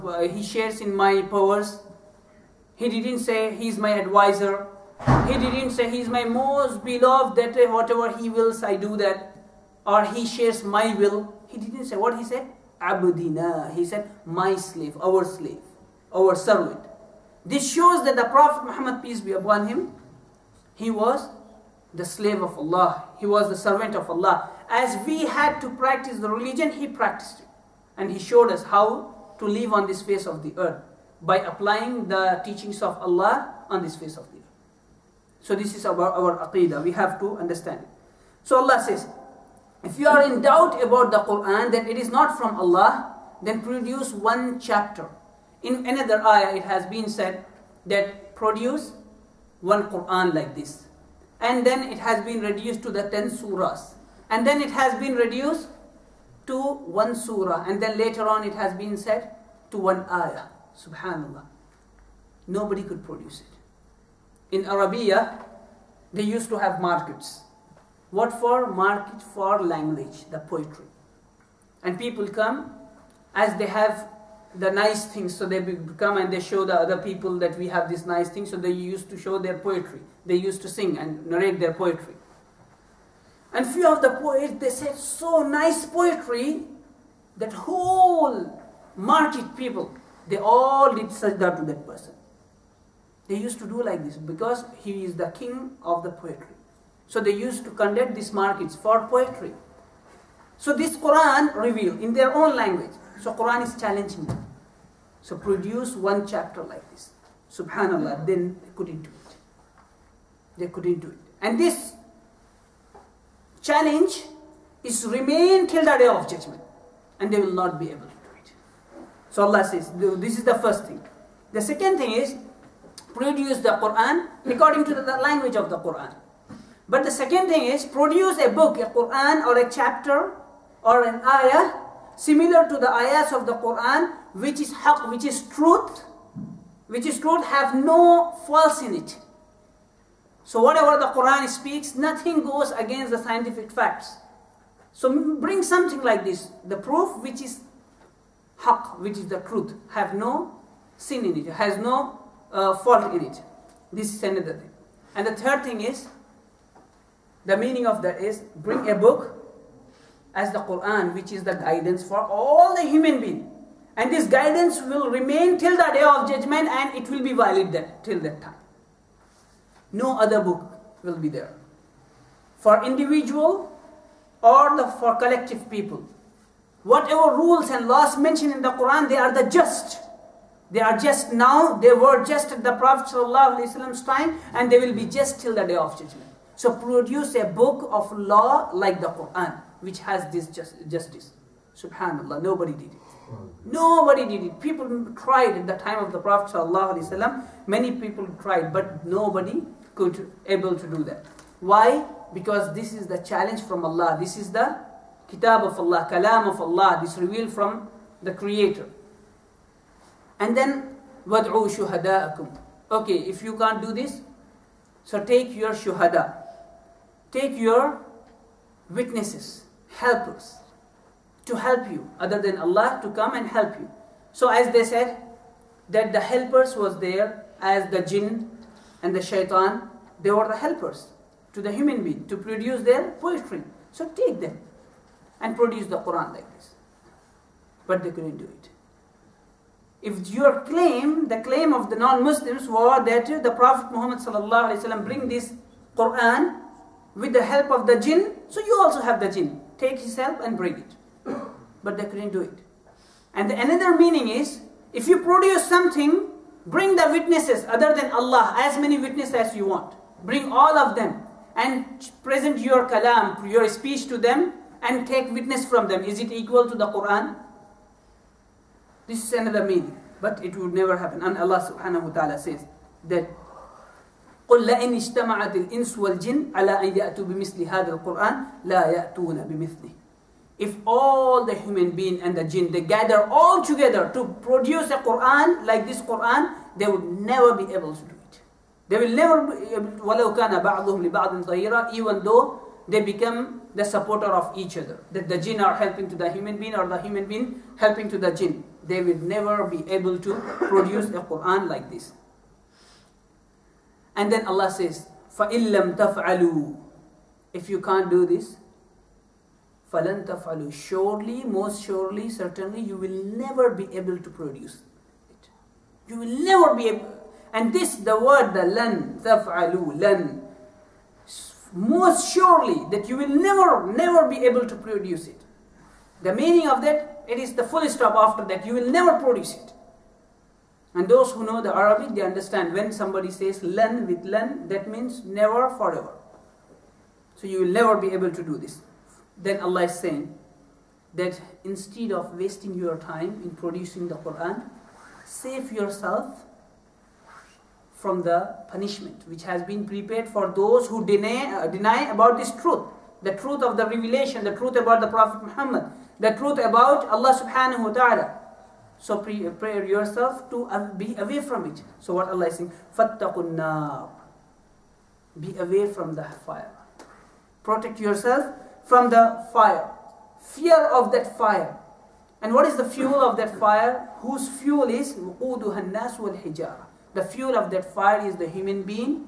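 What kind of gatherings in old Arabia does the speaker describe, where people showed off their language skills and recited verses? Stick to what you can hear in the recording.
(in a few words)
Markets for poetry.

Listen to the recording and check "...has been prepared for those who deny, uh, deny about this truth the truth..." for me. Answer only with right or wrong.
right.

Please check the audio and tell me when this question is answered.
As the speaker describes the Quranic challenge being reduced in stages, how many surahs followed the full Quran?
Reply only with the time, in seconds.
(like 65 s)
53 s.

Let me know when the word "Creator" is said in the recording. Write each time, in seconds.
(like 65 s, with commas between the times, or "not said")
208 s.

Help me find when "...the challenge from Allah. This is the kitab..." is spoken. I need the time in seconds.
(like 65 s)
203 s.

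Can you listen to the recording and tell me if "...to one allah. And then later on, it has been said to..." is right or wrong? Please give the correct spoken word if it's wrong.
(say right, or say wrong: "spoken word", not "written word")
wrong: "surah", not "allah".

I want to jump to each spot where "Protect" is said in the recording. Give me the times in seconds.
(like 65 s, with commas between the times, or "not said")
367 s.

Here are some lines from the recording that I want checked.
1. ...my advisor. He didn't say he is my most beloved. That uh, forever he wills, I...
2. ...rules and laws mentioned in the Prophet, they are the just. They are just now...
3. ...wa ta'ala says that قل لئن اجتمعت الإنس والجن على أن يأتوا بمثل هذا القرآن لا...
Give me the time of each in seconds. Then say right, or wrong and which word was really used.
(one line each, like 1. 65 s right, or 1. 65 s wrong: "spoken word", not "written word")
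1. 3 s wrong: "whatever", not "forever"
2. 177 s wrong: "Quran", not "Prophet"
3. 272 s right.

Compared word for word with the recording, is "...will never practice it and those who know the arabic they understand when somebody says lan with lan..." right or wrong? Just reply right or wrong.
wrong.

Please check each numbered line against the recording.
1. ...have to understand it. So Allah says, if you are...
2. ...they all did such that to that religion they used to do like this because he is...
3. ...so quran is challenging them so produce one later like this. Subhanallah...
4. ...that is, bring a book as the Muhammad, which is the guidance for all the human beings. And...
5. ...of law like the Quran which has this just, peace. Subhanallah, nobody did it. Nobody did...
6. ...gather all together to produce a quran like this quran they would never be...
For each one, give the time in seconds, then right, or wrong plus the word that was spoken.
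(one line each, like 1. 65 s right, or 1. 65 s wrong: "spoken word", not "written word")
1. 36 s right
2. 90 s wrong: "person", not "religion"
3. 103 s wrong: "chapter", not "later"
4. 158 s wrong: "Quran", not "Muhammad"
5. 187 s wrong: "justice", not "peace"
6. 282 s right.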